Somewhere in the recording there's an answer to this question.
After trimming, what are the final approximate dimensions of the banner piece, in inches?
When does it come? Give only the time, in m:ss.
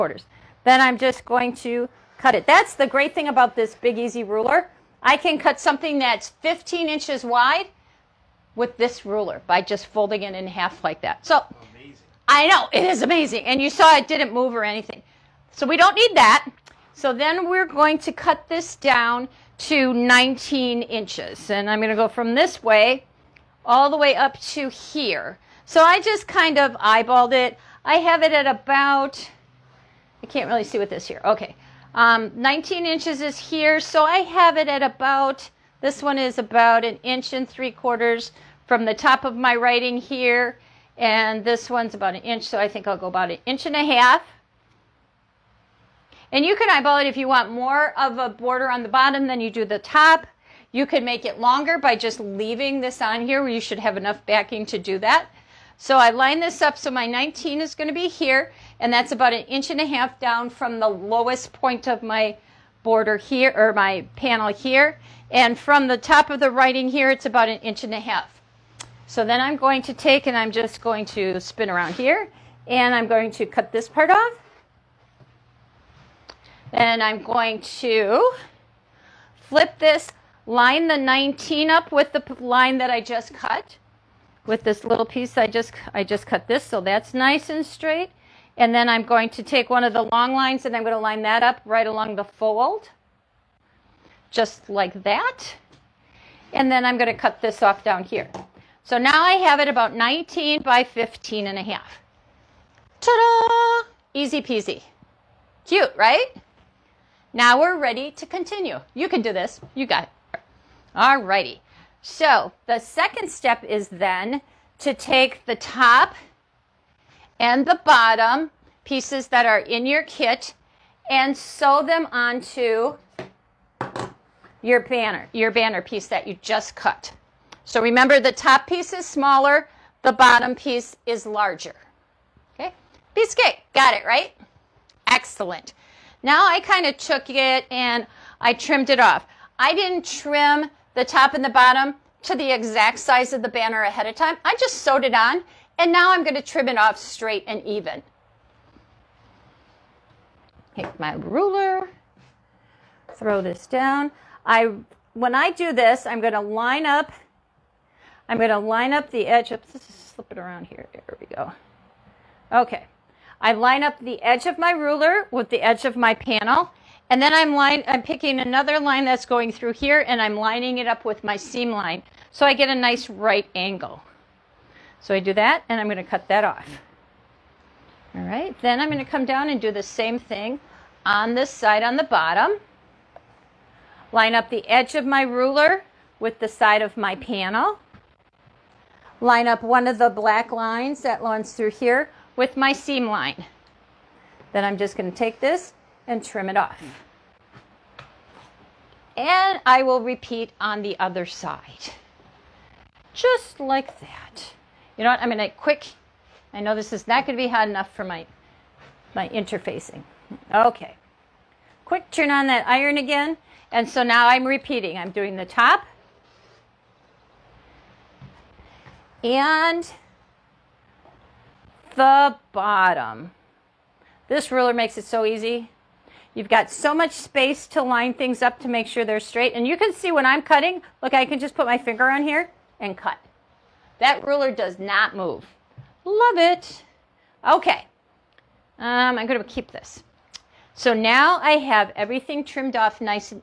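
1:39.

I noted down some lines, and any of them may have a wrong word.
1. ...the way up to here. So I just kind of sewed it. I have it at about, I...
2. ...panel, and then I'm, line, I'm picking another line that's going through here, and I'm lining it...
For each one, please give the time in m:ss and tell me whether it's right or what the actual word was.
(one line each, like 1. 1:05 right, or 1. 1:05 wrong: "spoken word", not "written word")
1. 0:23 wrong: "eyeballed", not "sewed"
2. 2:46 right.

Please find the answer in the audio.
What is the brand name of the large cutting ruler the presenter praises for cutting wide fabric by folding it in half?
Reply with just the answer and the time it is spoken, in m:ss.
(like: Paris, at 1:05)
Big Easy, at 0:03.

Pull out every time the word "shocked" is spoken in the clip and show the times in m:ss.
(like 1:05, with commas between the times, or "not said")
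not said.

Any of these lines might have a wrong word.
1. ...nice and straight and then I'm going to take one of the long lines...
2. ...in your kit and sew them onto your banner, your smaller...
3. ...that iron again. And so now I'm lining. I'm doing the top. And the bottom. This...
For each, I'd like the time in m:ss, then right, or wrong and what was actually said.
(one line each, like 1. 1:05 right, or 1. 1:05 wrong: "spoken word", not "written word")
1. 1:27 right
2. 1:59 wrong: "banner", not "smaller"
3. 3:32 wrong: "repeating", not "lining".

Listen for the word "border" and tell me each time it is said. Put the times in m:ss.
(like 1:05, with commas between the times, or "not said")
0:48, 1:02.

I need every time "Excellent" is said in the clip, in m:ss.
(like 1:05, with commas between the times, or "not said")
2:15.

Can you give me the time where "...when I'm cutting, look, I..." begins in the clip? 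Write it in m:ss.
3:50.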